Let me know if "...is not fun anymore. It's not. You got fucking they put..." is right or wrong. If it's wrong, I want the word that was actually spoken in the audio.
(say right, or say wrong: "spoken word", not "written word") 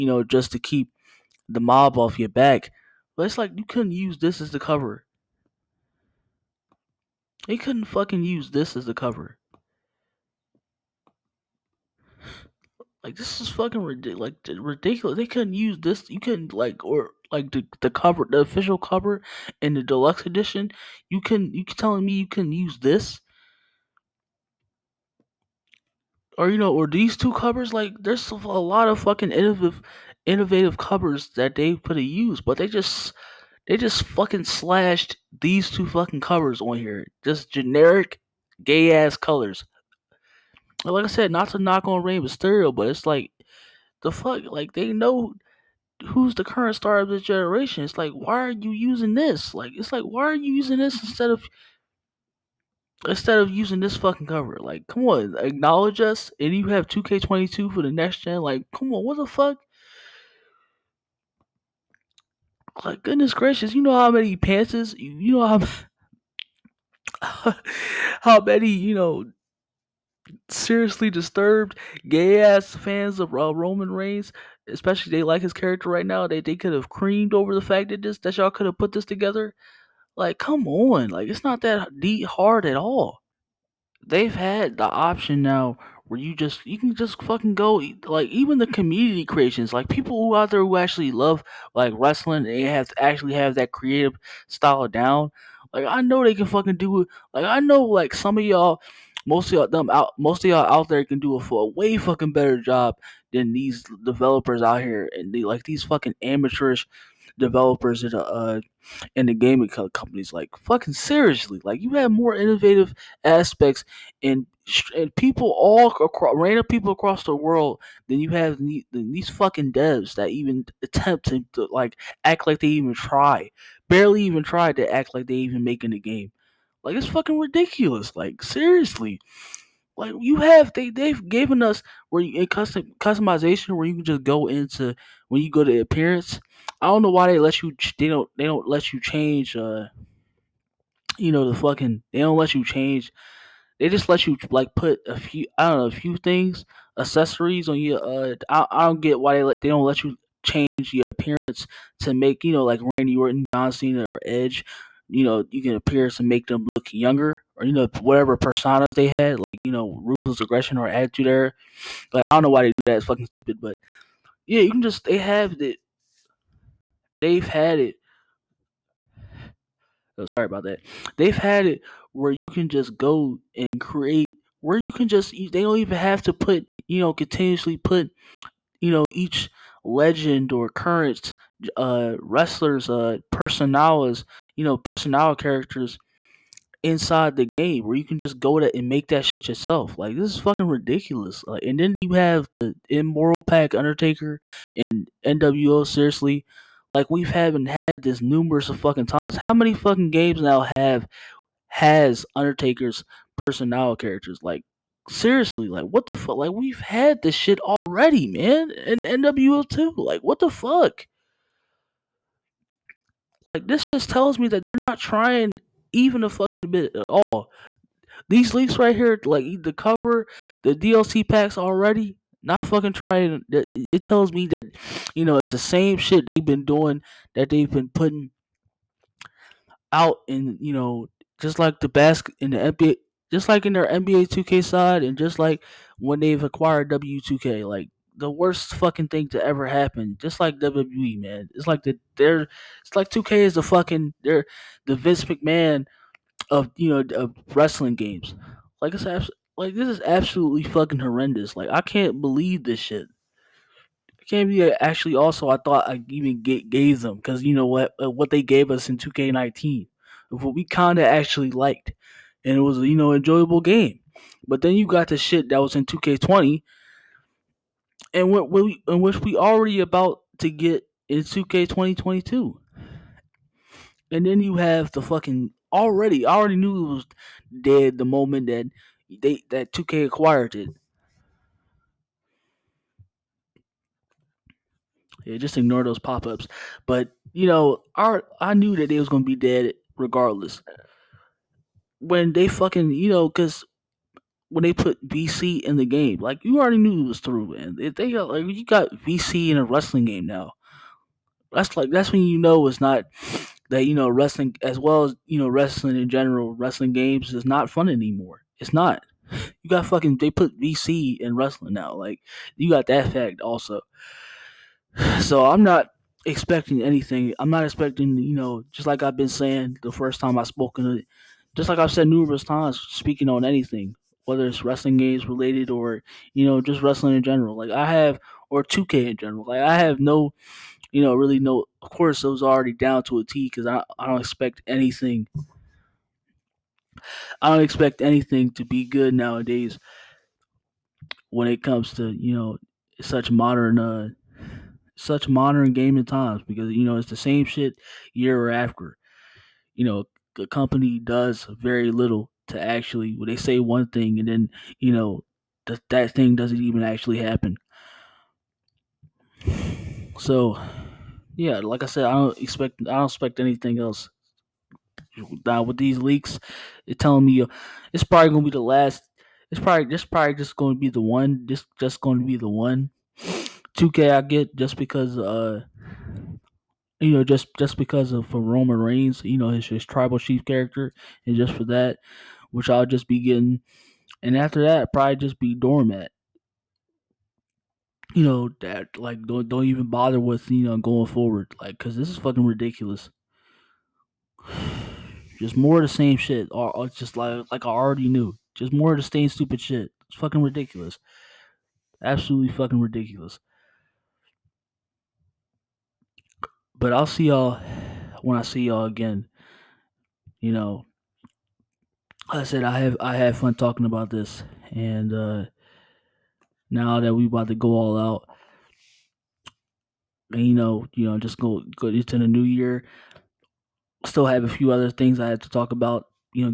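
right.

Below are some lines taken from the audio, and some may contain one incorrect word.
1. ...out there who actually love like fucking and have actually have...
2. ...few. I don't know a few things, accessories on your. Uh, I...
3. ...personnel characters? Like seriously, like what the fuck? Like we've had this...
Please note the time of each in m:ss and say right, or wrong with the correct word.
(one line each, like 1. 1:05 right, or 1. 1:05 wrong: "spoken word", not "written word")
1. 1:30 wrong: "wrestling", not "fucking"
2. 2:25 right
3. 3:23 right.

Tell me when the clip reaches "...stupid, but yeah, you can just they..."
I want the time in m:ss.
2:43.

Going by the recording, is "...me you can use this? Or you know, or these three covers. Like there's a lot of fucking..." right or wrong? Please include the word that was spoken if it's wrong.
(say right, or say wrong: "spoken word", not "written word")
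wrong: "two", not "three".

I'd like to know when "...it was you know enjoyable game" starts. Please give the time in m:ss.
4:22.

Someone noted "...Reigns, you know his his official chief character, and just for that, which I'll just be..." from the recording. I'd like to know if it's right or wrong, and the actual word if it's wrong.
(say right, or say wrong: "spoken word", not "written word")
wrong: "tribal", not "official".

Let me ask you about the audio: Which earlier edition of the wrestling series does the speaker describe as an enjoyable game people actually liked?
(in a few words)
2K19.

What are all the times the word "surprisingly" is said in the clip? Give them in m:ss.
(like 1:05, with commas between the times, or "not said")
not said.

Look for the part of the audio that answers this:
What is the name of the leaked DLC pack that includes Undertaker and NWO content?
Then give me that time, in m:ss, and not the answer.
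3:12.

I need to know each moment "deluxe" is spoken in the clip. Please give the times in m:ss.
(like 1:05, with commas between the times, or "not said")
0:19.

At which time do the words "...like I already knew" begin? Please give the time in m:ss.
6:37.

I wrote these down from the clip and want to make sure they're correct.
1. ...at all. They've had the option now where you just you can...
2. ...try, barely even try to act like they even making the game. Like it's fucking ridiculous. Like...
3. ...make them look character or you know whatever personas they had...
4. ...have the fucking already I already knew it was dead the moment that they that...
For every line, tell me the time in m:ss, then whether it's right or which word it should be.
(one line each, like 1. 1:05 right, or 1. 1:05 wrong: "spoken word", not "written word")
1. 1:22 right
2. 2:02 right
3. 2:36 wrong: "younger", not "character"
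4. 4:34 right.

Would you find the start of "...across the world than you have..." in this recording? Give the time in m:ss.
1:56.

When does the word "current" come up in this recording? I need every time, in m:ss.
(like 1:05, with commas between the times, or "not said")
0:46, 3:00.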